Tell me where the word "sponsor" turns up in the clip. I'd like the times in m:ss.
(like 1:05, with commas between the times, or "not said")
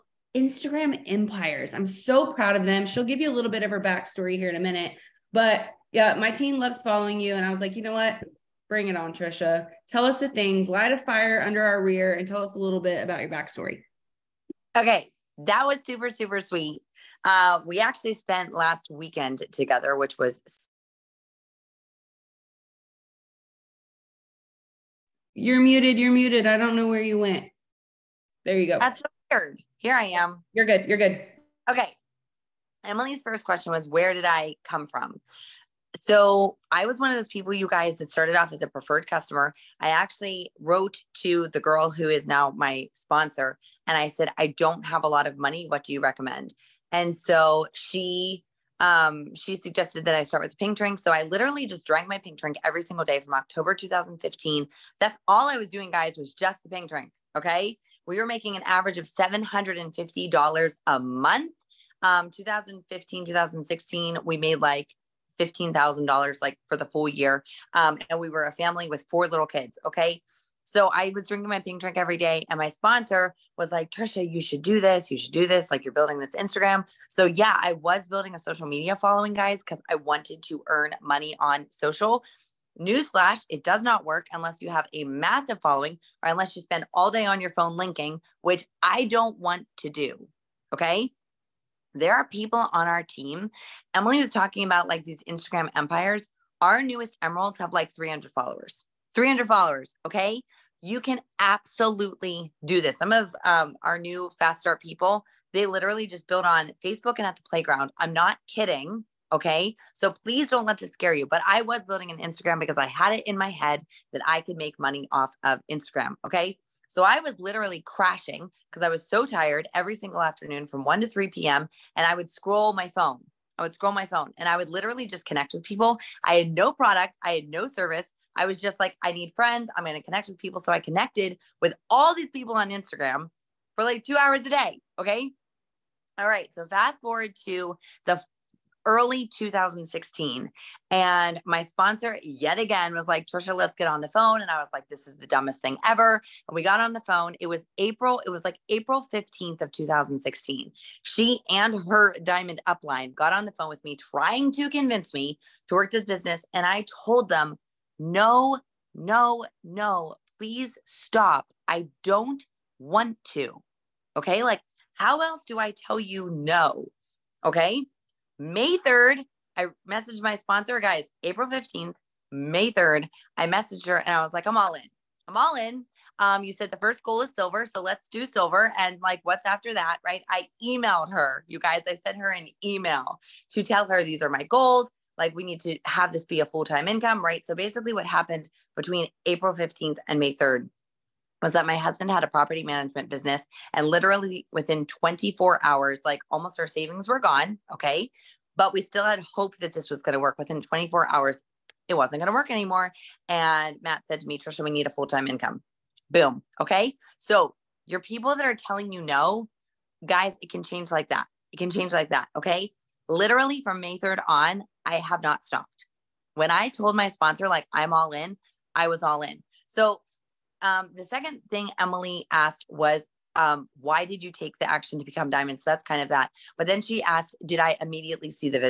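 0:42, 1:12, 2:21, 2:50, 3:37.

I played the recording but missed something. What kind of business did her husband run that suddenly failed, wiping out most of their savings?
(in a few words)
property management.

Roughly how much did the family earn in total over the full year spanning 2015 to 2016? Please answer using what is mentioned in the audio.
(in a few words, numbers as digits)
$15,000.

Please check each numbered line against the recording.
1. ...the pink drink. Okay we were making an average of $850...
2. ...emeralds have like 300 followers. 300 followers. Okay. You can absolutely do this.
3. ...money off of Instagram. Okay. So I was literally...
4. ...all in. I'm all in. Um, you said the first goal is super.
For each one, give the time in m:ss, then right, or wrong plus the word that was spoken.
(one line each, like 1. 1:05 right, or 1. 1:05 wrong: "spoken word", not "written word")
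1. 0:56 wrong: "750", not "850"
2. 1:37 right
3. 1:54 right
4. 2:54 wrong: "silver", not "super".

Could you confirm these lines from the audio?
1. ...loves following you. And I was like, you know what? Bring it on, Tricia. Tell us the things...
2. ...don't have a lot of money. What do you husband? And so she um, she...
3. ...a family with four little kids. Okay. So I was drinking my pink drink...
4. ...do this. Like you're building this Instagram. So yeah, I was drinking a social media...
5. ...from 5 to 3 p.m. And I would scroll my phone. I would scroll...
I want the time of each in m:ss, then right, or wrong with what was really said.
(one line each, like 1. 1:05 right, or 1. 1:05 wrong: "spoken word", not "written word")
1. 0:06 right
2. 0:44 wrong: "recommend", not "husband"
3. 1:08 right
4. 1:15 wrong: "building", not "drinking"
5. 2:00 wrong: "1", not "5".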